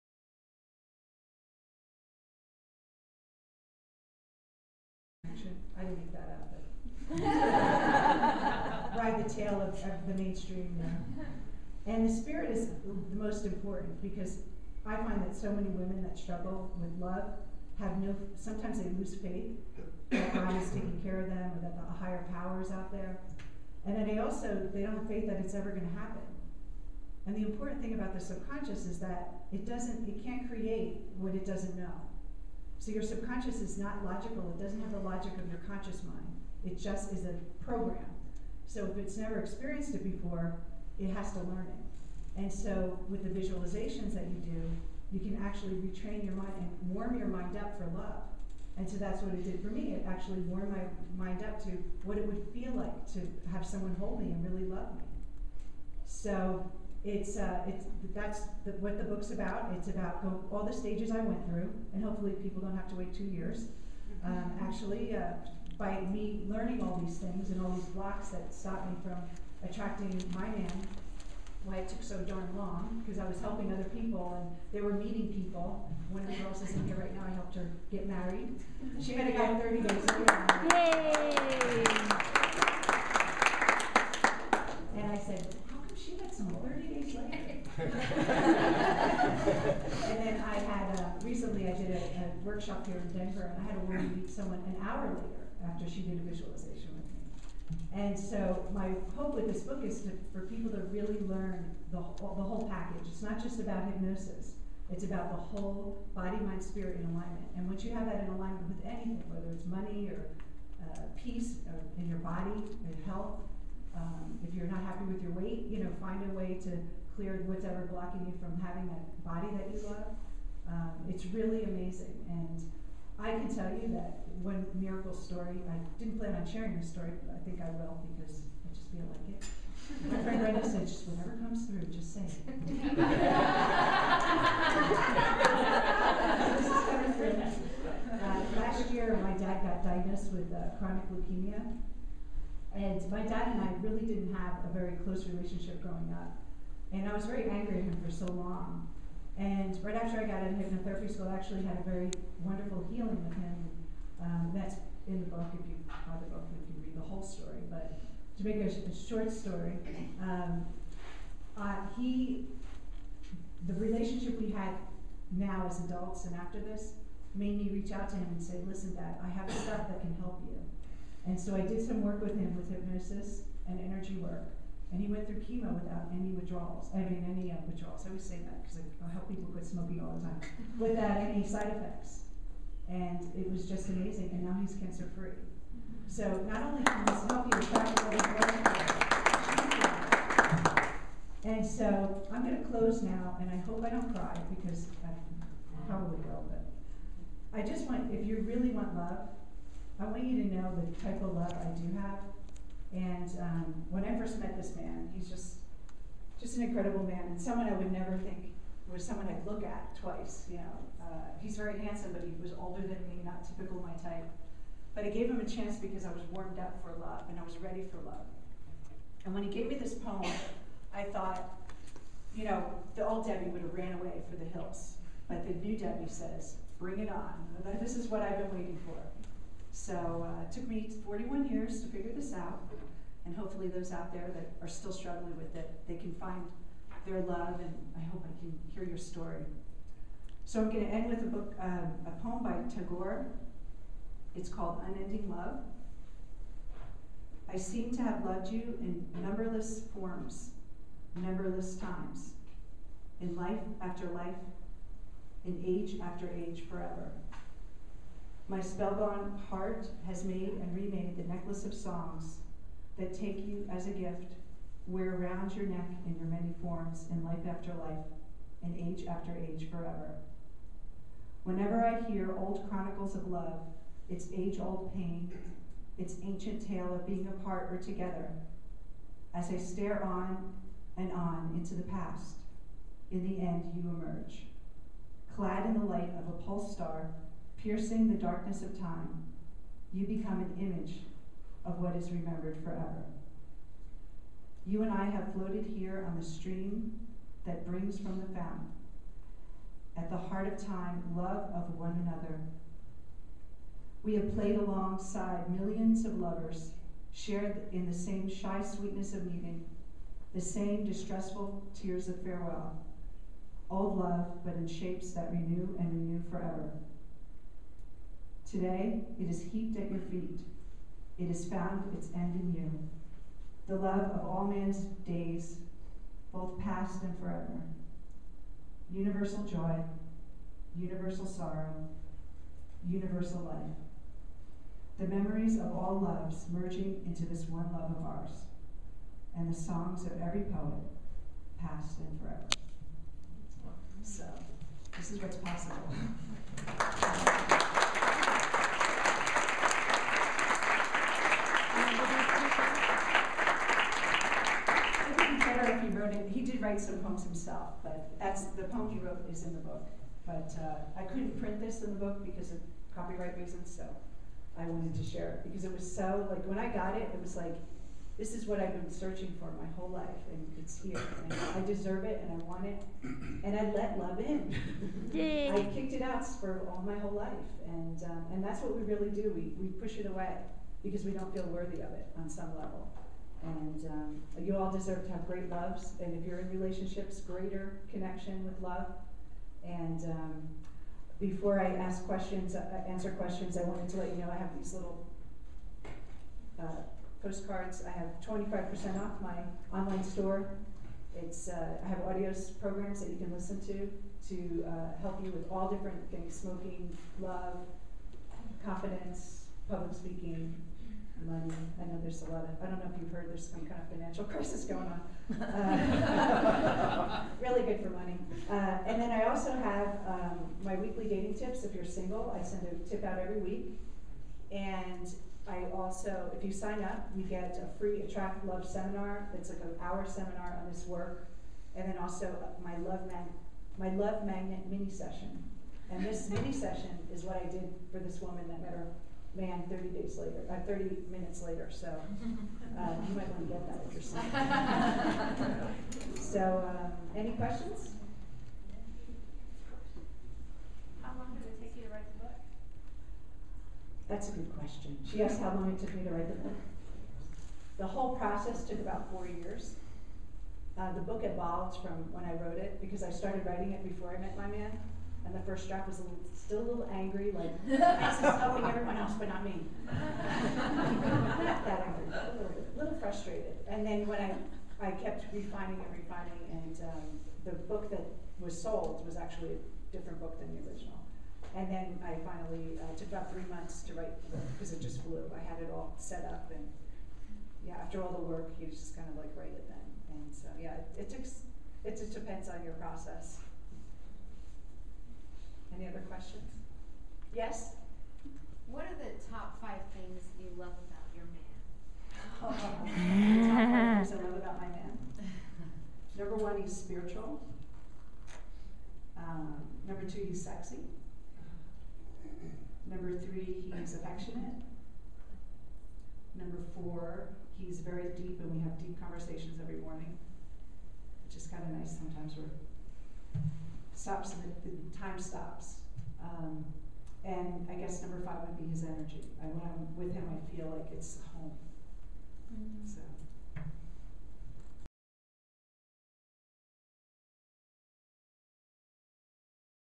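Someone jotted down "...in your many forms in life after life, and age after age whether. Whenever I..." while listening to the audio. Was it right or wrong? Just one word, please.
wrong.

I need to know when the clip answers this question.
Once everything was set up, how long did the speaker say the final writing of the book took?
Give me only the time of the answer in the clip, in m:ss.
8:03.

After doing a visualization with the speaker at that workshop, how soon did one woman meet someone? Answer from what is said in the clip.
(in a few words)
an hour later.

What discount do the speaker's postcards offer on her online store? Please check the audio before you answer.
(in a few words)
25%.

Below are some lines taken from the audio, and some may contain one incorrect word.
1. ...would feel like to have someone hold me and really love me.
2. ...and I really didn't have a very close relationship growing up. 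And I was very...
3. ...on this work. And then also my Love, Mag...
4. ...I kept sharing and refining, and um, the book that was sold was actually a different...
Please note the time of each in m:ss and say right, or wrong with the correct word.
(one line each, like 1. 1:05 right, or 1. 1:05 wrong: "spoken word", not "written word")
1. 0:52 right
2. 2:23 right
3. 7:10 right
4. 7:54 wrong: "refining", not "sharing".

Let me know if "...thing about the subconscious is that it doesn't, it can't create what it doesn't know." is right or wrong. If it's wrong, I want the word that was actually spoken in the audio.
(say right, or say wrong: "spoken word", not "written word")
right.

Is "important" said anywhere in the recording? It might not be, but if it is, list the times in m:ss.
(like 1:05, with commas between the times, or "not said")
0:13, 0:27.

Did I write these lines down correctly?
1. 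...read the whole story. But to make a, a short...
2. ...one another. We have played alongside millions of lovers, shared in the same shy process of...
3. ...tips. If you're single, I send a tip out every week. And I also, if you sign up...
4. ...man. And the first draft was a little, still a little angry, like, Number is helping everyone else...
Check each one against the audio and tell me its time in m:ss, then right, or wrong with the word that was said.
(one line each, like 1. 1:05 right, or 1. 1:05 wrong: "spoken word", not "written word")
1. 2:36 right
2. 5:01 wrong: "sweetness", not "process"
3. 7:01 right
4. 7:44 wrong: "Max", not "Number".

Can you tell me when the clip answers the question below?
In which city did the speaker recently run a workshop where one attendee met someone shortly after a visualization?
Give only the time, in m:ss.
1:33.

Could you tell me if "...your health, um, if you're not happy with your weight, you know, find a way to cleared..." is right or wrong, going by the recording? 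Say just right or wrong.
right.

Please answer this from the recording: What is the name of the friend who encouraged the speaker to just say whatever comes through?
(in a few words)
Brenda.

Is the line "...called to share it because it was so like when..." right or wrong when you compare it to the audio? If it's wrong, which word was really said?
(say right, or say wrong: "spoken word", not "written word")
wrong: "wanted", not "called".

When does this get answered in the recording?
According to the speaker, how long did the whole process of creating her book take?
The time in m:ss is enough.
7:39.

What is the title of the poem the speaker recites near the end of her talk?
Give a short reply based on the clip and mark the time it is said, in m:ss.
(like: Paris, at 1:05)
Unending Love, at 4:04.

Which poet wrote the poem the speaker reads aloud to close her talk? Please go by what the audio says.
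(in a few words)
Tagore.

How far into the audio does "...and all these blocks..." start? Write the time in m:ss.
1:07.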